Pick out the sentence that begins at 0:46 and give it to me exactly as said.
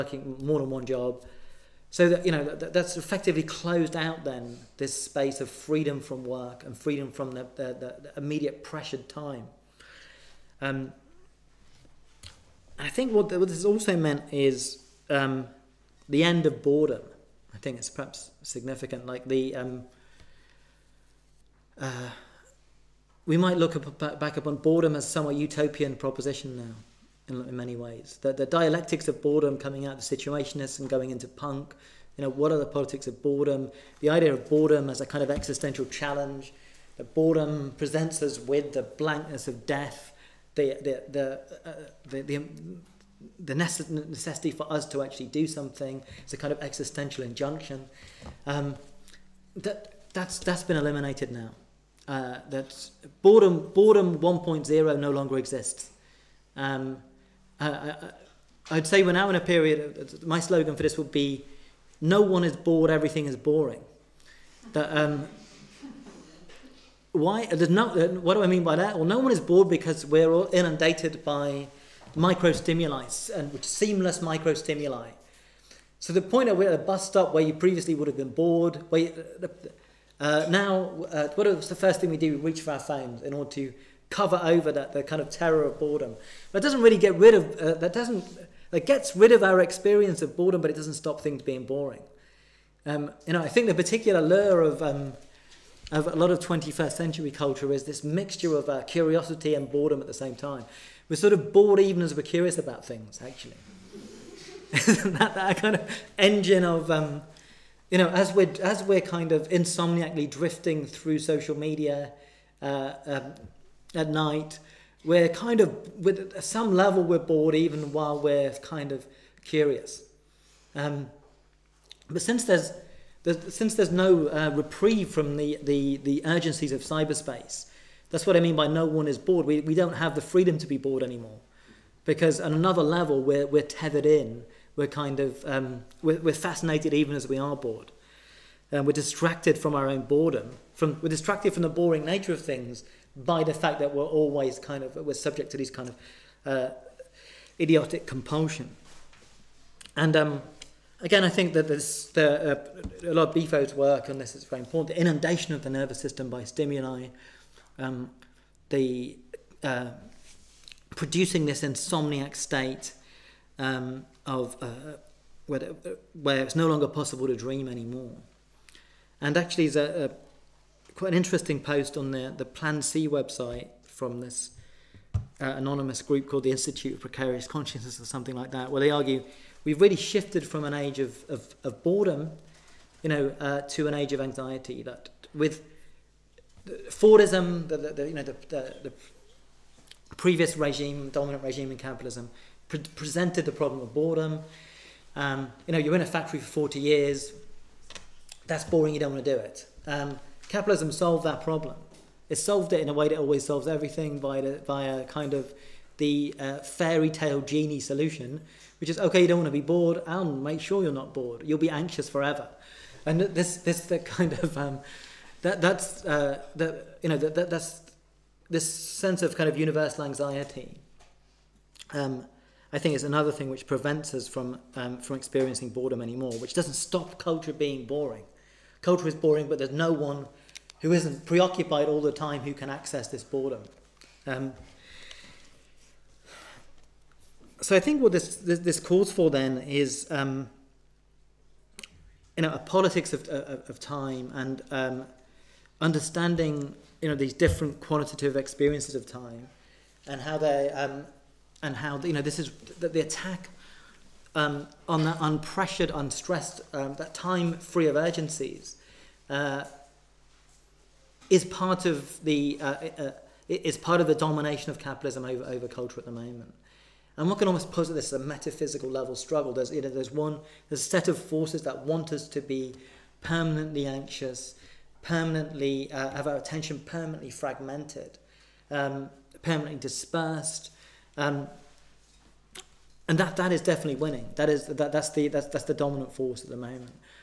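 It's a kind of existential injunction.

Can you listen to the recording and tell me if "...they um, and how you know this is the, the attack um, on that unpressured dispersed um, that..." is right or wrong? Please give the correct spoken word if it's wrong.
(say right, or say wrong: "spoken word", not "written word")
wrong: "unstressed", not "dispersed".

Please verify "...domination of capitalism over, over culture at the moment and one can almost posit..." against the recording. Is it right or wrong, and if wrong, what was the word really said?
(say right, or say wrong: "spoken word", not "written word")
right.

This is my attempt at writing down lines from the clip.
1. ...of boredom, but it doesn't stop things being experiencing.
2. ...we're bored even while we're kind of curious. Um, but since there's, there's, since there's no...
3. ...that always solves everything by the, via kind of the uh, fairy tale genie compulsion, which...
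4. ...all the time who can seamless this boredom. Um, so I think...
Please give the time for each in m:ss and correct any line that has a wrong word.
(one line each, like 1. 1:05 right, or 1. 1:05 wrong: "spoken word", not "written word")
1. 1:30 wrong: "boring", not "experiencing"
2. 1:57 right
3. 3:23 wrong: "solution", not "compulsion"
4. 3:51 wrong: "access", not "seamless".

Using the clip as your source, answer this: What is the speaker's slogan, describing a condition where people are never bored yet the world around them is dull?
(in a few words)
No one is bored. Everything is boring.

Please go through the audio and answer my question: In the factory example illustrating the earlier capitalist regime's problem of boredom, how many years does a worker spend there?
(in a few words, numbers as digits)
40 years.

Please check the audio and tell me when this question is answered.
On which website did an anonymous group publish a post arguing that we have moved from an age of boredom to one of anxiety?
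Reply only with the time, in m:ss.
2:52.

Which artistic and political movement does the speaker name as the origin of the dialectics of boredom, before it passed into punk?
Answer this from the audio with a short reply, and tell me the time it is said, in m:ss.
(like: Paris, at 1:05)
The Situationists, at 0:30.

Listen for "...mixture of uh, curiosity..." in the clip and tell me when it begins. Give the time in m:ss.
1:38.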